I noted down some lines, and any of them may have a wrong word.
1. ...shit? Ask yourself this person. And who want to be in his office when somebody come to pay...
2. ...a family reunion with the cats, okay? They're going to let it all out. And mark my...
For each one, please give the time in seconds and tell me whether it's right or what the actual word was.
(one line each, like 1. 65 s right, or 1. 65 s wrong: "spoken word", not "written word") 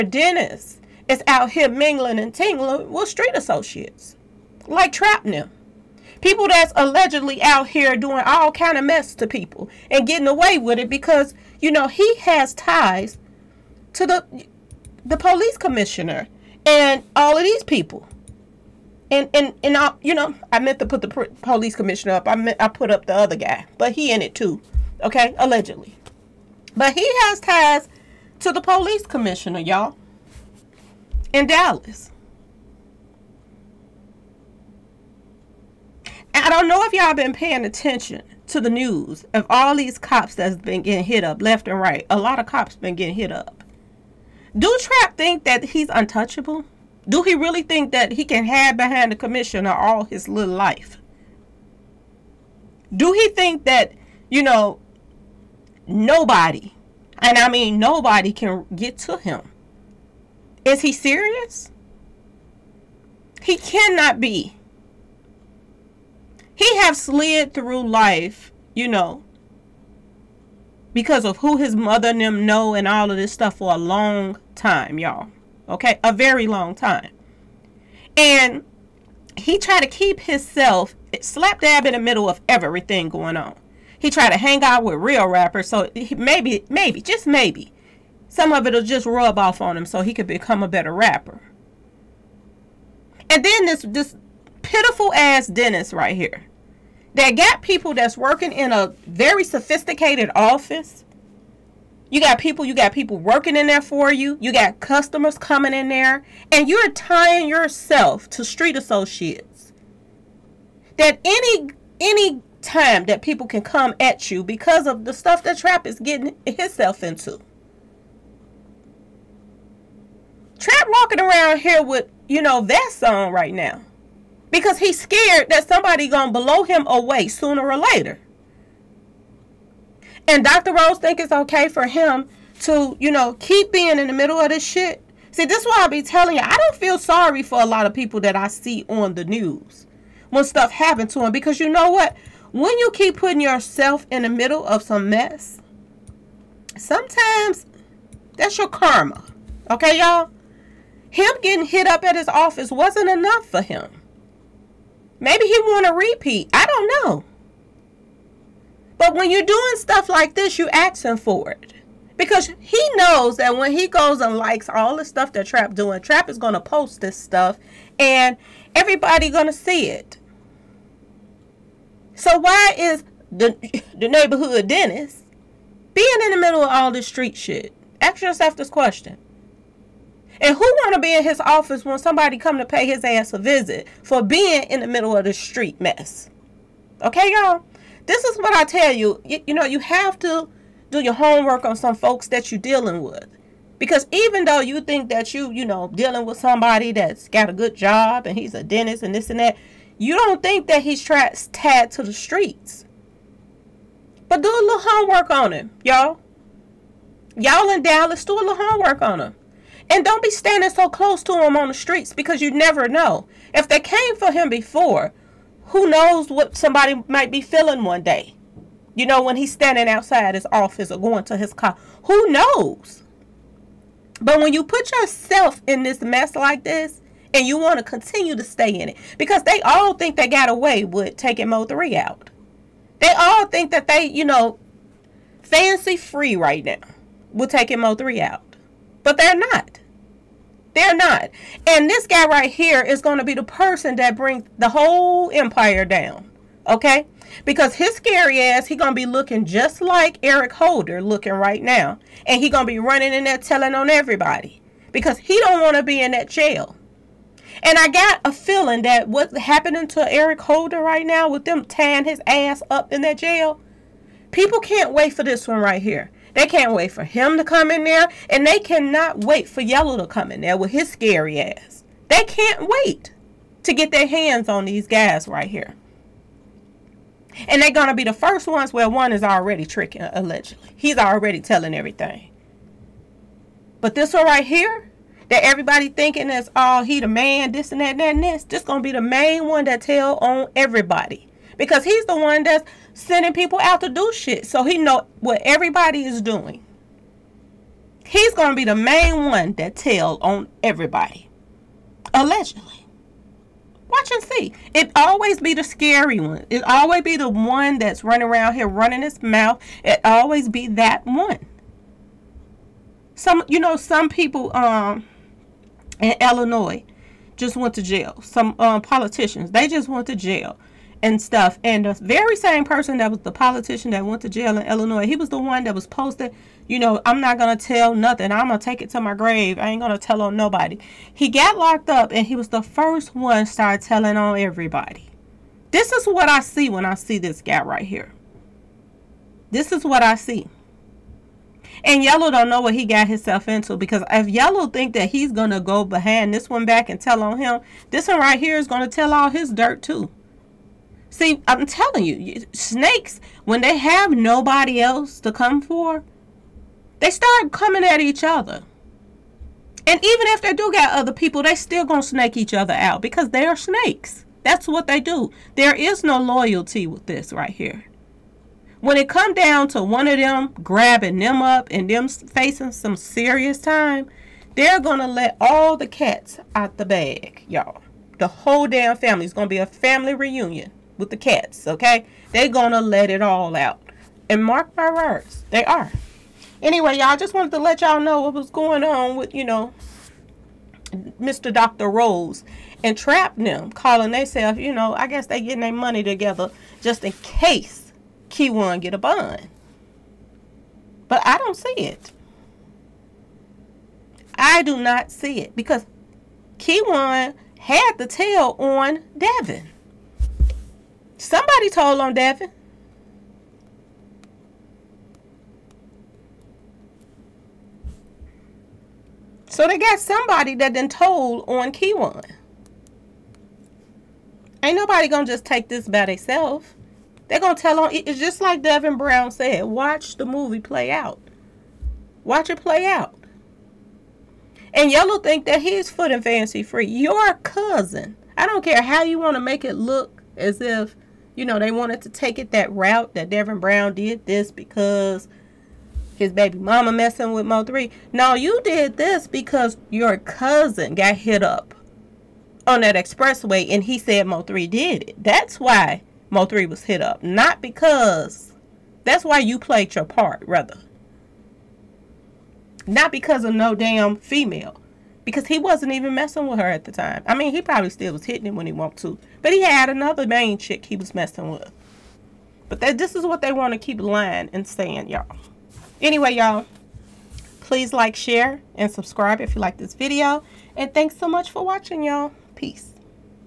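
1. 177 s wrong: "question", not "person"
2. 379 s right.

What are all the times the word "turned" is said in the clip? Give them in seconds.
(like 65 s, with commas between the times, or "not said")
not said.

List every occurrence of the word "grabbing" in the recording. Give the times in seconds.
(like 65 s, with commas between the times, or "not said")
370 s.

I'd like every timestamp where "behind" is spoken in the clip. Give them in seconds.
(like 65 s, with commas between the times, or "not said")
48 s, 345 s.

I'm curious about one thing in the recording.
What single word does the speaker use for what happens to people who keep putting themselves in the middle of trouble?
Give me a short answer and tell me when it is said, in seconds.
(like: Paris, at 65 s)
karma, at 148 s.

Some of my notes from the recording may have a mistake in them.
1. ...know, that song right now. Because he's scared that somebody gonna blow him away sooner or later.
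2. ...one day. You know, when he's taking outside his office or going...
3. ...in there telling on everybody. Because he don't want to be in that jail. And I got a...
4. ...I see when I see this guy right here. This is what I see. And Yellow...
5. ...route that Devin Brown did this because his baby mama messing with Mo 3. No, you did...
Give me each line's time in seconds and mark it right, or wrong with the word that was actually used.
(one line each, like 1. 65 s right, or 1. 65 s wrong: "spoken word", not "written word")
1. 122 s right
2. 217 s wrong: "standing", not "taking"
3. 253 s right
4. 336 s right
5. 442 s right.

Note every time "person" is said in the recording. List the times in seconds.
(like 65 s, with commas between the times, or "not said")
243 s, 322 s.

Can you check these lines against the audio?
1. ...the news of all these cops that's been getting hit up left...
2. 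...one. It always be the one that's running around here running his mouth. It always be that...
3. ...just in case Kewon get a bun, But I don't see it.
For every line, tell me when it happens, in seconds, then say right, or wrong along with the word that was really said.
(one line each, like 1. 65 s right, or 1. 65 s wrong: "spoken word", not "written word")
1. 38 s right
2. 306 s right
3. 396 s right.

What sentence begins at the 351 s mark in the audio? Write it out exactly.
See, I'm telling you, snakes, when they have nobody else to come for, they start coming at each other.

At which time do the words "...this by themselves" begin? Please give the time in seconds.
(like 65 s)
425 s.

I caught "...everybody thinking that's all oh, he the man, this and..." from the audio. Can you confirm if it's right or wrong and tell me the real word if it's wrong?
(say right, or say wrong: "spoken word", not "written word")
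right.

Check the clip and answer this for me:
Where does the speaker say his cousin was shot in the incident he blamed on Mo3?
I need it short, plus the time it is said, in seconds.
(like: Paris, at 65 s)
expressway, at 452 s.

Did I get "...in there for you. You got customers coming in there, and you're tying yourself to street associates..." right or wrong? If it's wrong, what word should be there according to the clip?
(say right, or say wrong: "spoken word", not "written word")
right.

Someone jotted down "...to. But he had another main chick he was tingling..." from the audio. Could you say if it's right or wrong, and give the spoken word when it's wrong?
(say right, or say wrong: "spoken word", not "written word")
wrong: "messing", not "tingling".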